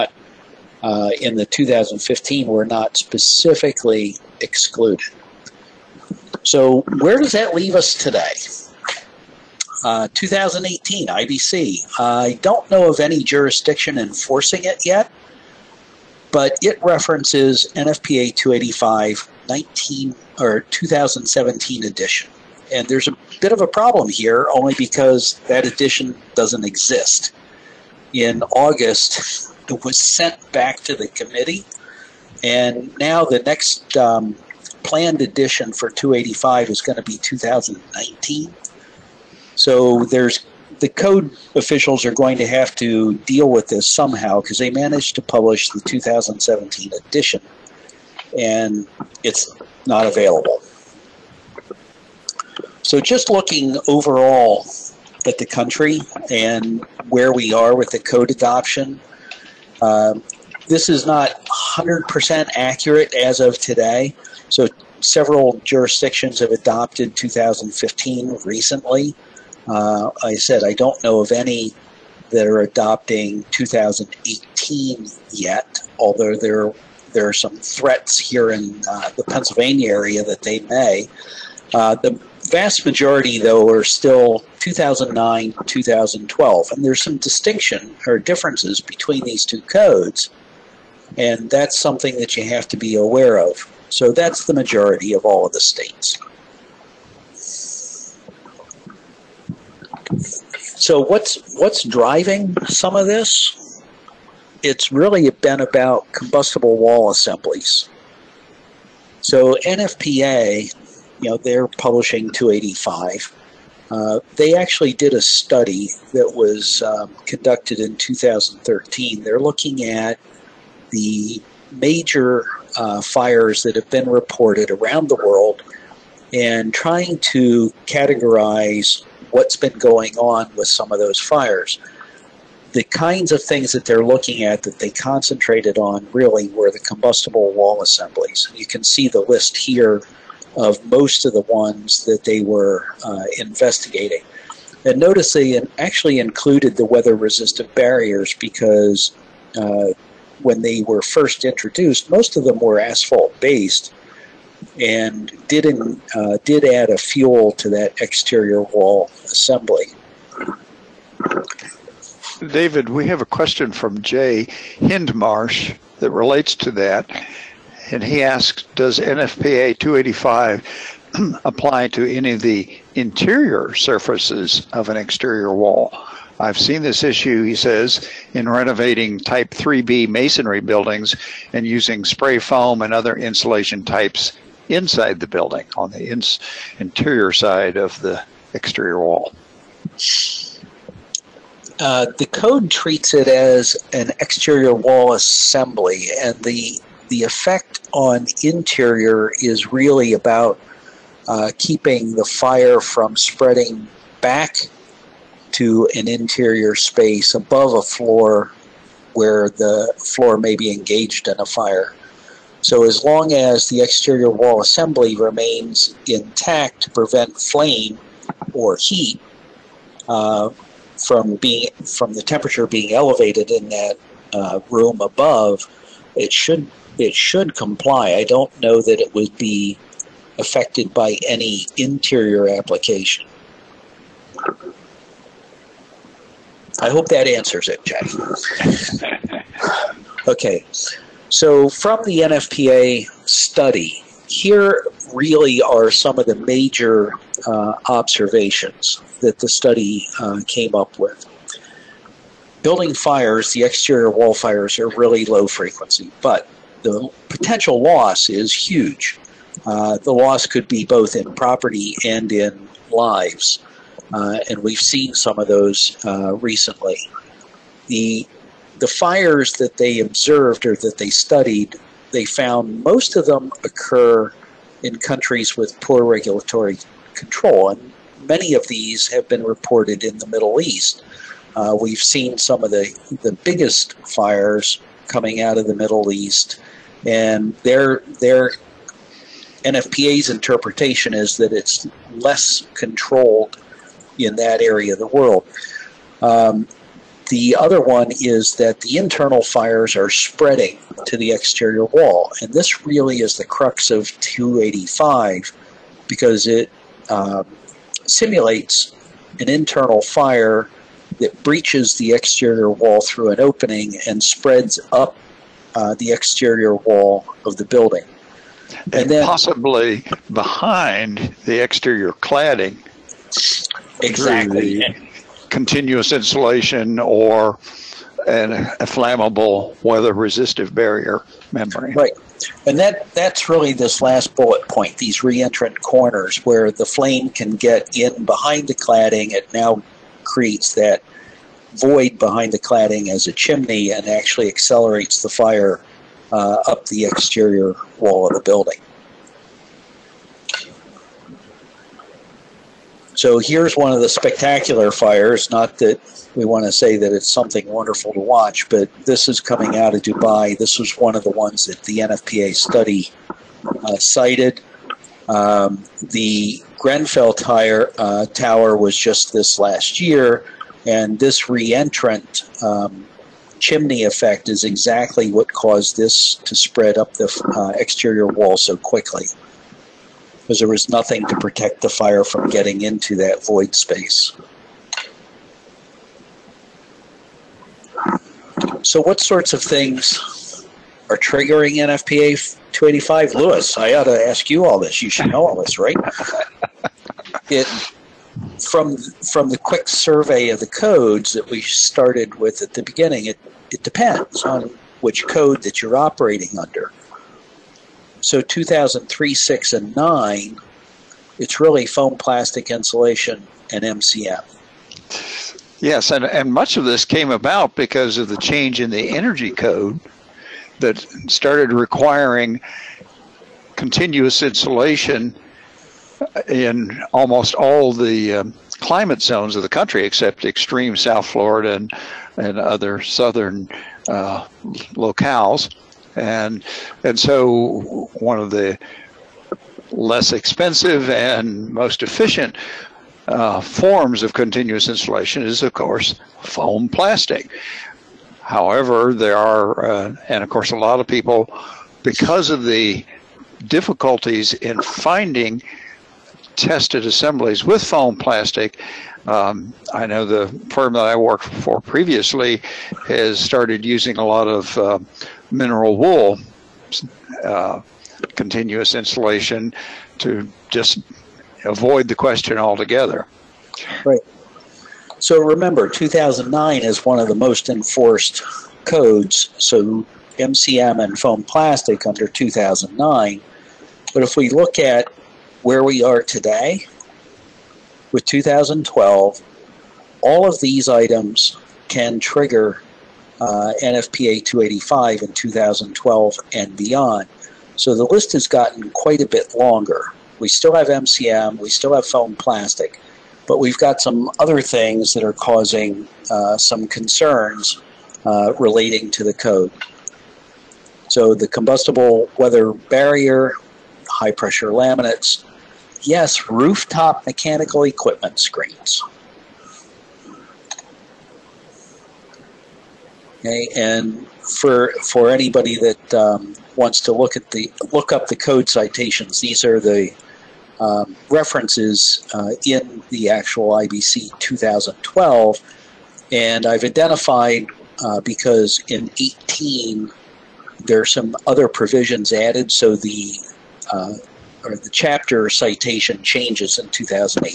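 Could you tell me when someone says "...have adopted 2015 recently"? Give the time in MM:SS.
01:06.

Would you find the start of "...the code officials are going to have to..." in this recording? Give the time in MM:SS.
00:40.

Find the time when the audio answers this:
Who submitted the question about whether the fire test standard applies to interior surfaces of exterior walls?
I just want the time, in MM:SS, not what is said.
02:44.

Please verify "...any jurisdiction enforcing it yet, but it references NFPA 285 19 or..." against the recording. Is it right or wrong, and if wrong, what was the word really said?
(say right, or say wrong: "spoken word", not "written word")
right.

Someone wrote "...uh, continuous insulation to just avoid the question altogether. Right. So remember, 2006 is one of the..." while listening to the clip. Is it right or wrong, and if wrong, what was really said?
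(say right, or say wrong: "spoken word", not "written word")
wrong: "2009", not "2006".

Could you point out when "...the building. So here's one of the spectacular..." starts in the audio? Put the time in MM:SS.
05:48.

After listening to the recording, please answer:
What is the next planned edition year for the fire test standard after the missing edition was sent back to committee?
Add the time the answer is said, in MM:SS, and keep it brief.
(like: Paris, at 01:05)
2019, at 00:37.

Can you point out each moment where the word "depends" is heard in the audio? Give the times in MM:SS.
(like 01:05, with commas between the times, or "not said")
06:43.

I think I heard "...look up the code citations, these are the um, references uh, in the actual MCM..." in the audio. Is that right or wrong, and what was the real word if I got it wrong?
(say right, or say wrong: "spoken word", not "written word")
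wrong: "IBC", not "MCM".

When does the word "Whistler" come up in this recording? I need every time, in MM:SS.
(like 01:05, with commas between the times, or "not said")
not said.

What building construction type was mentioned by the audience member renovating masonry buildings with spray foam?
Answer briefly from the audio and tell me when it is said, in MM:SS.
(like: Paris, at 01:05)
Type 3B, at 02:59.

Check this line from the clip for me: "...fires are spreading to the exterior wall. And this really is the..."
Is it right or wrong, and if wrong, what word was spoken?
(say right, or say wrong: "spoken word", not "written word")
right.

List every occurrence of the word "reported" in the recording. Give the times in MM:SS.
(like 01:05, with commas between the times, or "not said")
02:04, 04:39.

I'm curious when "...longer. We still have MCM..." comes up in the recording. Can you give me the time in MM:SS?
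08:19.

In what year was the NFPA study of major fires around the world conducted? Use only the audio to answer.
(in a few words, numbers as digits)
2013.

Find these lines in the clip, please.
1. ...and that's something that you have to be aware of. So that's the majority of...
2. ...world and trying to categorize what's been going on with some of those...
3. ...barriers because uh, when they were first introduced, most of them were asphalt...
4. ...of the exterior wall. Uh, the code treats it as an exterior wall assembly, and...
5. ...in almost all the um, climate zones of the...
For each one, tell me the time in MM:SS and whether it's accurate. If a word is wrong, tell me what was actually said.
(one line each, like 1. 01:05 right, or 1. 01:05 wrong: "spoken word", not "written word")
1. 01:31 right
2. 02:05 right
3. 02:27 right
4. 03:07 right
5. 07:06 right.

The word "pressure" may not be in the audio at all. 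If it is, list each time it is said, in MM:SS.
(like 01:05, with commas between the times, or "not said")
08:34.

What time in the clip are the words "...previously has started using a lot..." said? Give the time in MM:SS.
07:41.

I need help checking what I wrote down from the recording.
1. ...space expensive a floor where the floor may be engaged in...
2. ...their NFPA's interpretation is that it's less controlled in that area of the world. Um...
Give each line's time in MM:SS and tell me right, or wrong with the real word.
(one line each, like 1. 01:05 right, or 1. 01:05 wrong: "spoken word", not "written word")
1. 03:26 wrong: "above", not "expensive"
2. 04:48 right.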